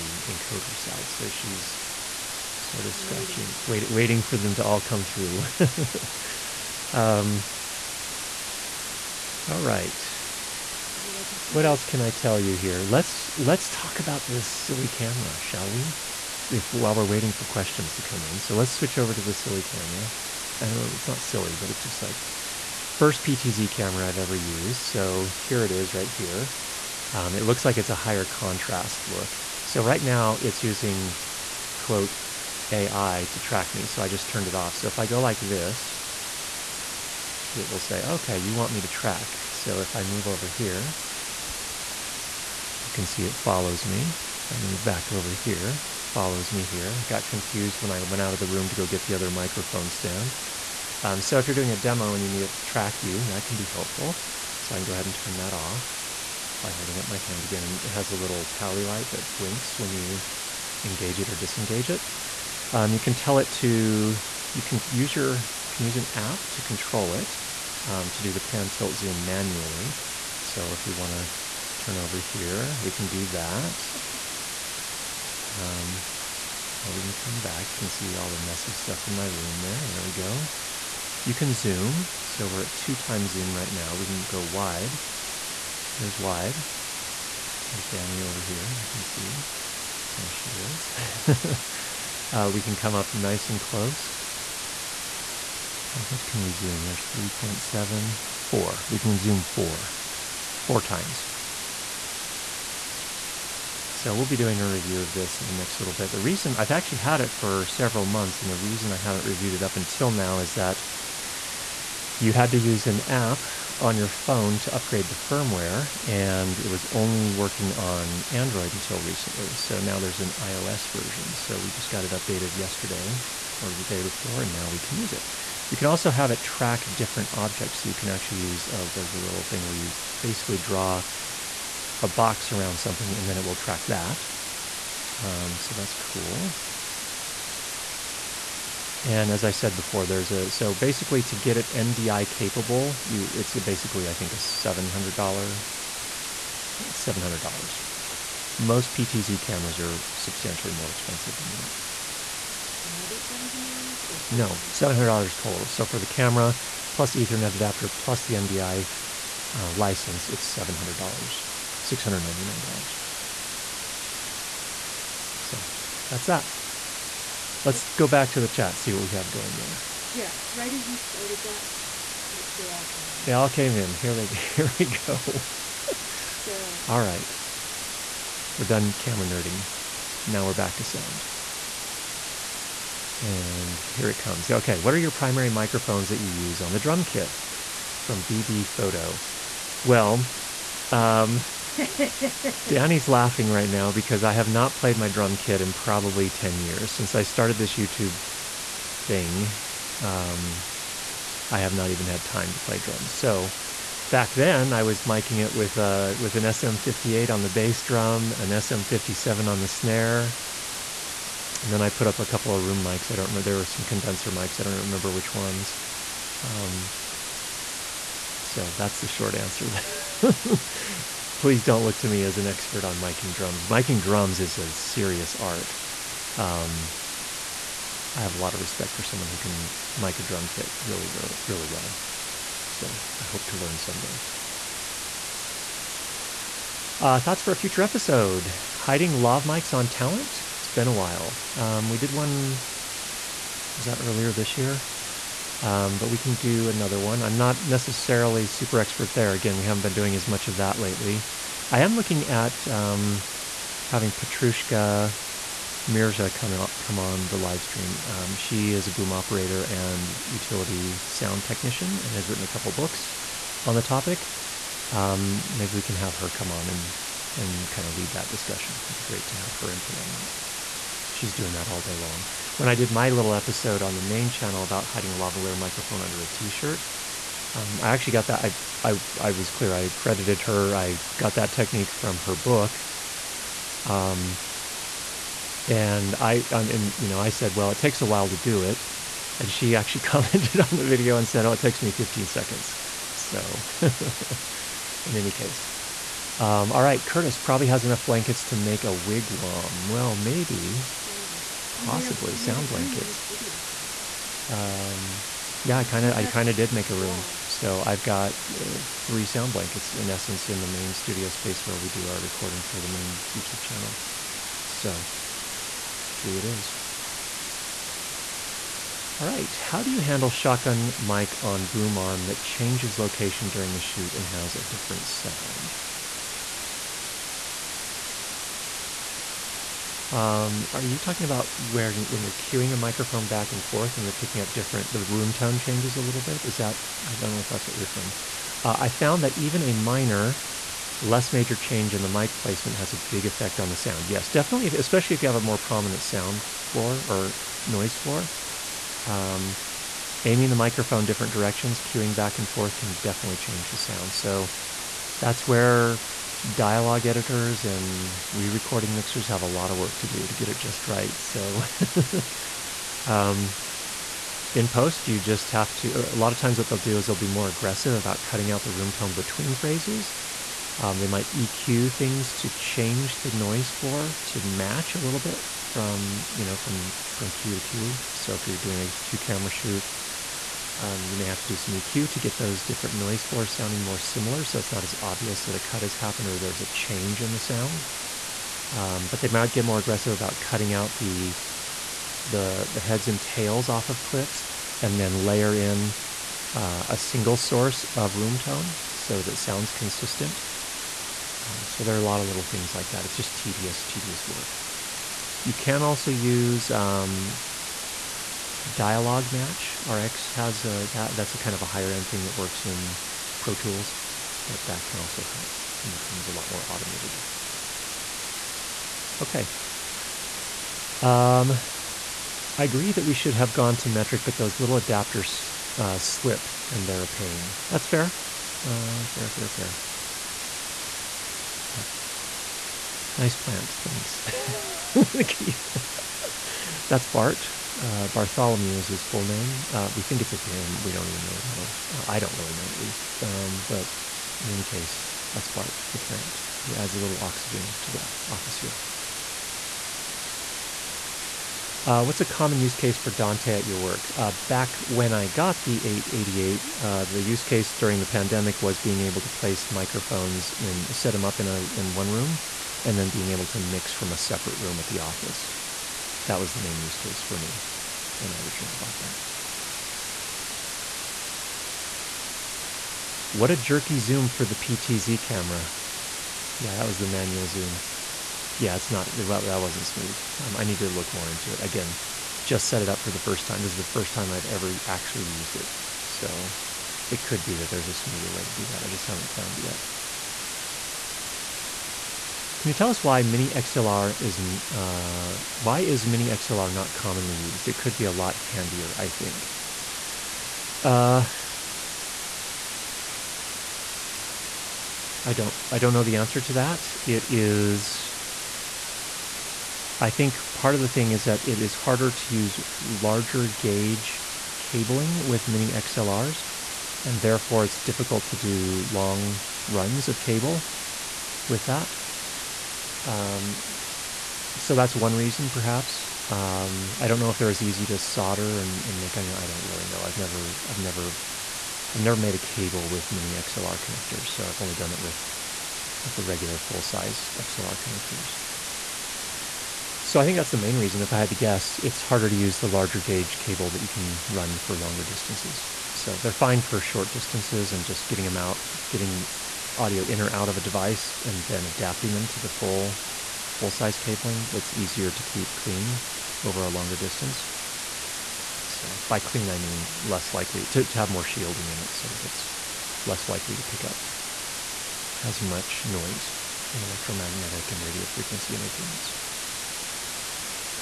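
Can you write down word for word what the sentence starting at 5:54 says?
So that's where dialogue editors and re-recording mixers have a lot of work to do to get it just right.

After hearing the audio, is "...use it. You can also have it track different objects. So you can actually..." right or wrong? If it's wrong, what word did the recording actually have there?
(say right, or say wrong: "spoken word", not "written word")
right.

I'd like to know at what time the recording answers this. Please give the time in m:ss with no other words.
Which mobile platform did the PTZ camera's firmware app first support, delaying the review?
1:58.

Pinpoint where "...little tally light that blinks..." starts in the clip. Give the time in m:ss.
0:58.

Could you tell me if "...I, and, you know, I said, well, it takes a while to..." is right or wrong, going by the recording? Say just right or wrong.
right.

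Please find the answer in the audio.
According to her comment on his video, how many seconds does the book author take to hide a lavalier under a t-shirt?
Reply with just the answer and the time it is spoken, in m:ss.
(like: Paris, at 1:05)
15 seconds, at 4:51.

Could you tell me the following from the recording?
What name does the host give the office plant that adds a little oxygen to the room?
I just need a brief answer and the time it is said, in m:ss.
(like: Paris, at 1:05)
Bartholomew, at 7:18.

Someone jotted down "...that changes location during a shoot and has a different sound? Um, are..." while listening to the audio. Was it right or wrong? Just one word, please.
right.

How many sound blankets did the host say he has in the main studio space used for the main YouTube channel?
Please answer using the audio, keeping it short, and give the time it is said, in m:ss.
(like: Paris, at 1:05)
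3, at 5:08.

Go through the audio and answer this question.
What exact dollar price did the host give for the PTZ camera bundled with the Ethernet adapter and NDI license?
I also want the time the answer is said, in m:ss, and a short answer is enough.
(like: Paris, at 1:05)
$699, at 2:41.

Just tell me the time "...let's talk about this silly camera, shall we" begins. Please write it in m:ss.
0:13.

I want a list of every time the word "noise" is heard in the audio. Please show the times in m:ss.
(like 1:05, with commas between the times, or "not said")
5:47, 6:13, 6:22, 9:25.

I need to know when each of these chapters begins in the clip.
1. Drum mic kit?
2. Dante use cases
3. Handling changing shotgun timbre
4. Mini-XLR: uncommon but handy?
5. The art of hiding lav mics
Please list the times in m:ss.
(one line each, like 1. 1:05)
1. 3:05
2. 7:31
3. 5:17
4. 8:11
5. 3:56.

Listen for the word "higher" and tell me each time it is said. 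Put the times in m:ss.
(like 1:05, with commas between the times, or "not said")
0:27, 6:51.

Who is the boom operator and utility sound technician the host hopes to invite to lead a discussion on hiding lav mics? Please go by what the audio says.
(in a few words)
Petrushka Mirza.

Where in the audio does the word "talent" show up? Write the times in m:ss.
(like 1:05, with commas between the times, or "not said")
3:59.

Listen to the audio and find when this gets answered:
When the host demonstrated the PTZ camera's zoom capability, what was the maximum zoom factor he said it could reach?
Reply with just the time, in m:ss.
1:38.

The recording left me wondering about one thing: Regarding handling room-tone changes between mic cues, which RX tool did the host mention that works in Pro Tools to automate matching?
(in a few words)
dialogue match.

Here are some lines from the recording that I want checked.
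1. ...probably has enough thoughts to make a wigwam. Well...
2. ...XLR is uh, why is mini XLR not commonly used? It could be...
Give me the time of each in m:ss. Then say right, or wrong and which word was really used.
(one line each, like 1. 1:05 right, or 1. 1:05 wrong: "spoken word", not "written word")
1. 4:57 wrong: "blankets", not "thoughts"
2. 8:13 right.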